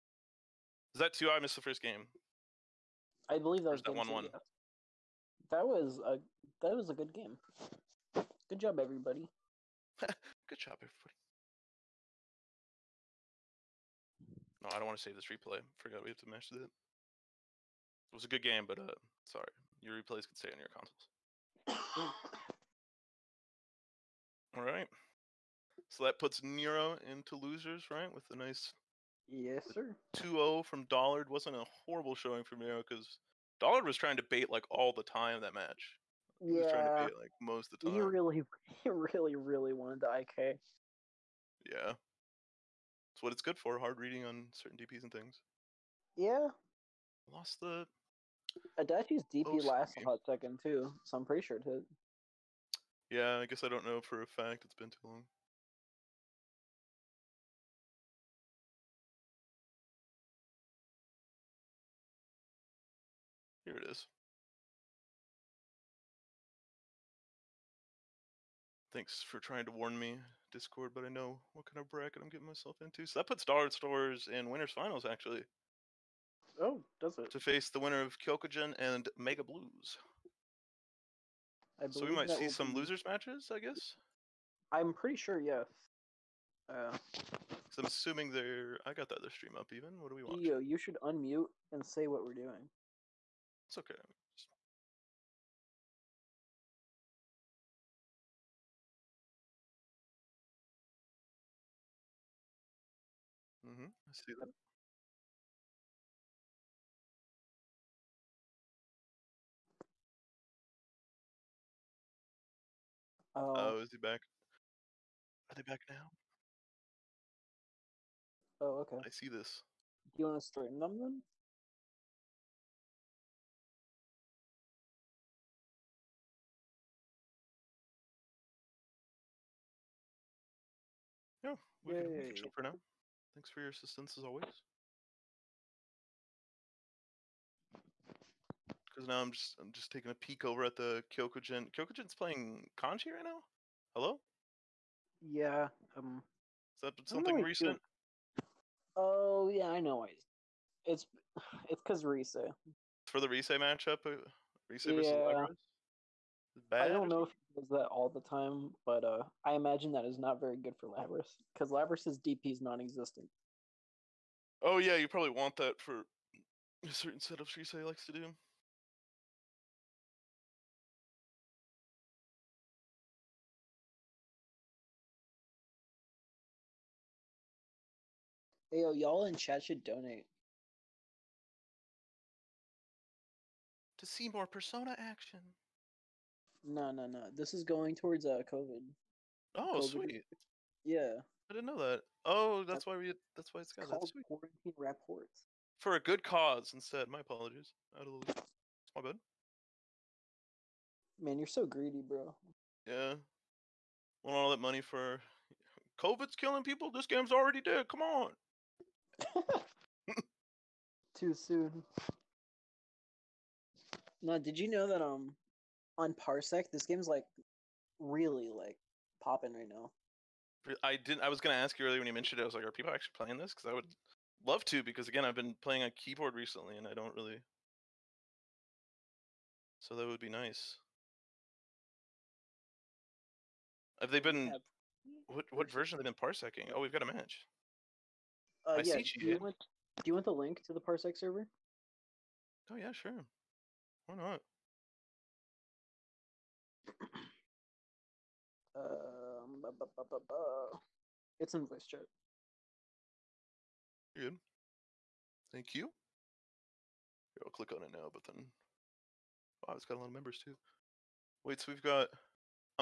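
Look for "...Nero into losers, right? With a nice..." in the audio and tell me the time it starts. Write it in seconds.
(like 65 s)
26 s.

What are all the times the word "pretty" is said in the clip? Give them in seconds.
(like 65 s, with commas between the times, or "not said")
51 s, 84 s.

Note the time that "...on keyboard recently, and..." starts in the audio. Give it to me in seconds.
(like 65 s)
225 s.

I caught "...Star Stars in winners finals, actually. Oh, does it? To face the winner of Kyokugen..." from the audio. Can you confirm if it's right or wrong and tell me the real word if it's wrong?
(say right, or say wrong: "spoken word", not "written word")
right.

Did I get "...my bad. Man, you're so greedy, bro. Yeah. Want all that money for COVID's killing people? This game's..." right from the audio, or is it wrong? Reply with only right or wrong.
right.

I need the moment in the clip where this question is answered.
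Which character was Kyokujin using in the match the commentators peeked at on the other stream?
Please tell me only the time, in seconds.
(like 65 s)
142 s.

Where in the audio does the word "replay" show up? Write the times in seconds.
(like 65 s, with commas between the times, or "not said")
15 s, 19 s.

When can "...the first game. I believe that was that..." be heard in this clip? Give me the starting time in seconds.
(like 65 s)
1 s.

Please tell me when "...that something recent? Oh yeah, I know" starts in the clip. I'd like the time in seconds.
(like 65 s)
146 s.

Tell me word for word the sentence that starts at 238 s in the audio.
Uh, I yeah, see do you, want, do you want the link to the Parsec server?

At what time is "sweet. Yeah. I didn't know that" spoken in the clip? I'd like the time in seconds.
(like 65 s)
189 s.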